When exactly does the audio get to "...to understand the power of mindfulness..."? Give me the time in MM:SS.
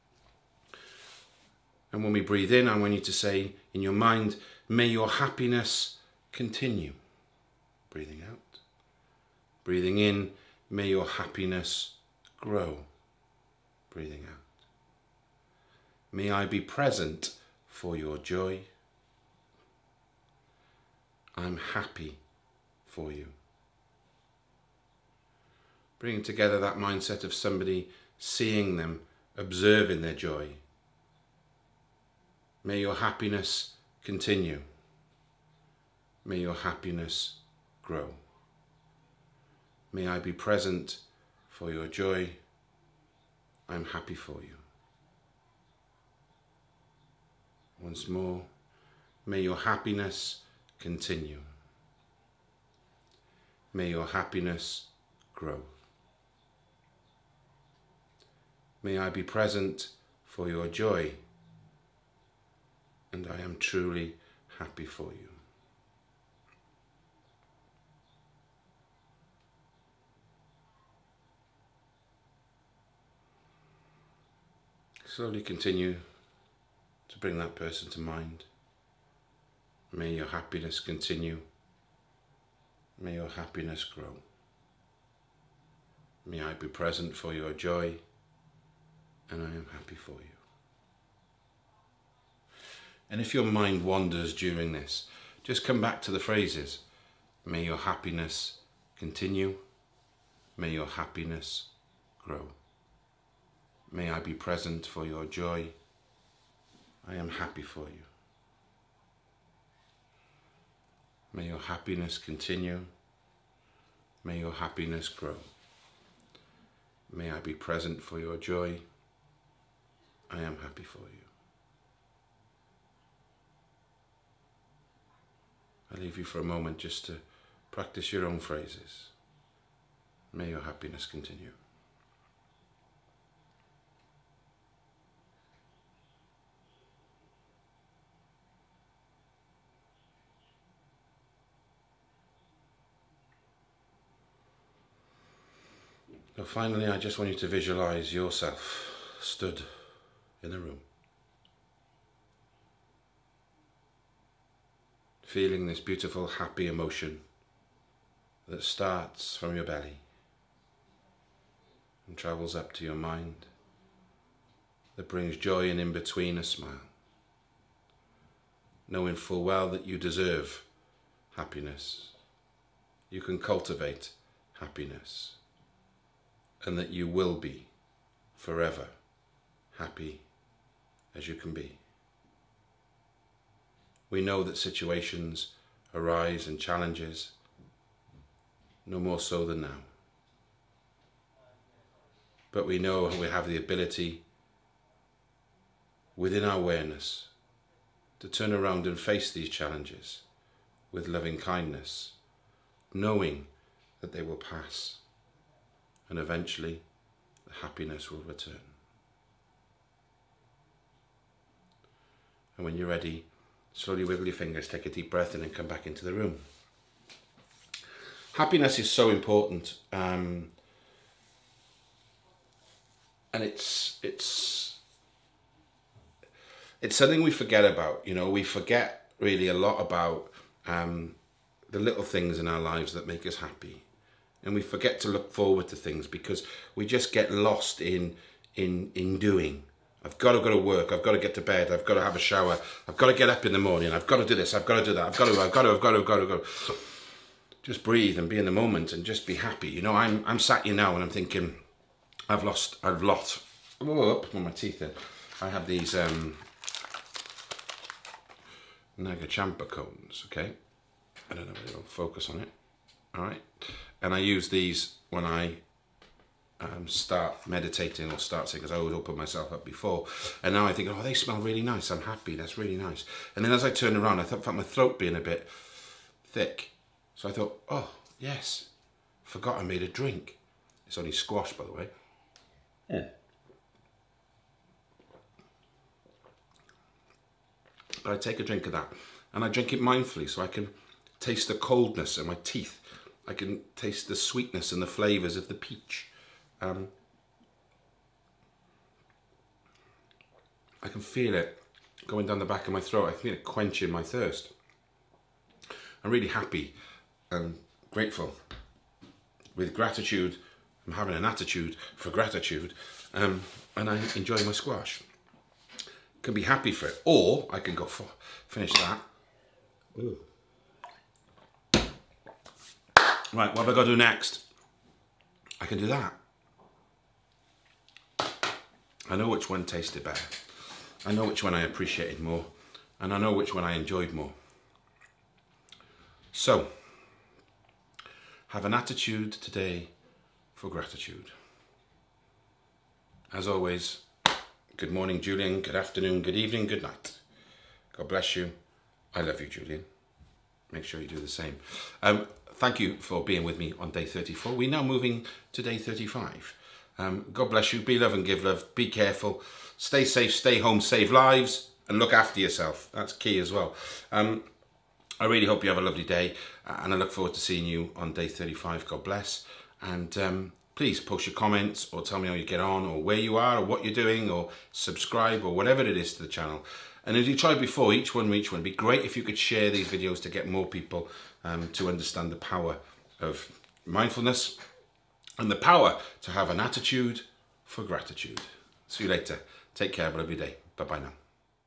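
06:21.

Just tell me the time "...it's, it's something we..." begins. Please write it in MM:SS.
03:44.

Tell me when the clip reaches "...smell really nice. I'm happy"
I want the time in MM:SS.
04:31.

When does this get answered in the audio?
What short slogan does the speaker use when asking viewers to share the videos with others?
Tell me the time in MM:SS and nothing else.
06:17.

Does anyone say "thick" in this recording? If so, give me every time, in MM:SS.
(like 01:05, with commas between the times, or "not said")
04:36.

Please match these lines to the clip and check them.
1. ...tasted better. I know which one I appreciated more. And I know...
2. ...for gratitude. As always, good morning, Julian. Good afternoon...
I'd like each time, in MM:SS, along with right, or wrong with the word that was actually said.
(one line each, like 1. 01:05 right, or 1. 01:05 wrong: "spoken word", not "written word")
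1. 05:29 right
2. 05:40 right.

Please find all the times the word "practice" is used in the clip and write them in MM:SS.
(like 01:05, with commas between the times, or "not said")
02:07.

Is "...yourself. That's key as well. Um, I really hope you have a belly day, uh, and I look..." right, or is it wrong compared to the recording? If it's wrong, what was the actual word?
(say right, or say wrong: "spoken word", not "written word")
wrong: "lovely", not "belly".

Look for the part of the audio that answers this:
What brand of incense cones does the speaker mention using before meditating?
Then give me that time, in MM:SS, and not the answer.
04:18.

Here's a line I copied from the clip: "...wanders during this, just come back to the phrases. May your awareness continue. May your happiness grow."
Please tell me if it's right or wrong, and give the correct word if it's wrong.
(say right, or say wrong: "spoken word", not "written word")
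wrong: "happiness", not "awareness".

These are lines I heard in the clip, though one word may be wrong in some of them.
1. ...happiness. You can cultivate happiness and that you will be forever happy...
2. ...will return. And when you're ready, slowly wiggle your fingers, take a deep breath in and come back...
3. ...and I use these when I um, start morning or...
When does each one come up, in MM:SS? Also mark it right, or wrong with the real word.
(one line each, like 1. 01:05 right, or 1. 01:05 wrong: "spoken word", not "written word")
1. 02:51 right
2. 03:28 right
3. 04:24 wrong: "meditating", not "morning".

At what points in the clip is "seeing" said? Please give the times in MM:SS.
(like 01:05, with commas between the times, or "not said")
00:28, 06:07.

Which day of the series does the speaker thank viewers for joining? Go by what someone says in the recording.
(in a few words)
34.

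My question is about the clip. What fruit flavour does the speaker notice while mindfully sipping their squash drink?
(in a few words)
Peach.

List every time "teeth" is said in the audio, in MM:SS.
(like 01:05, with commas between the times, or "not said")
04:14, 04:52.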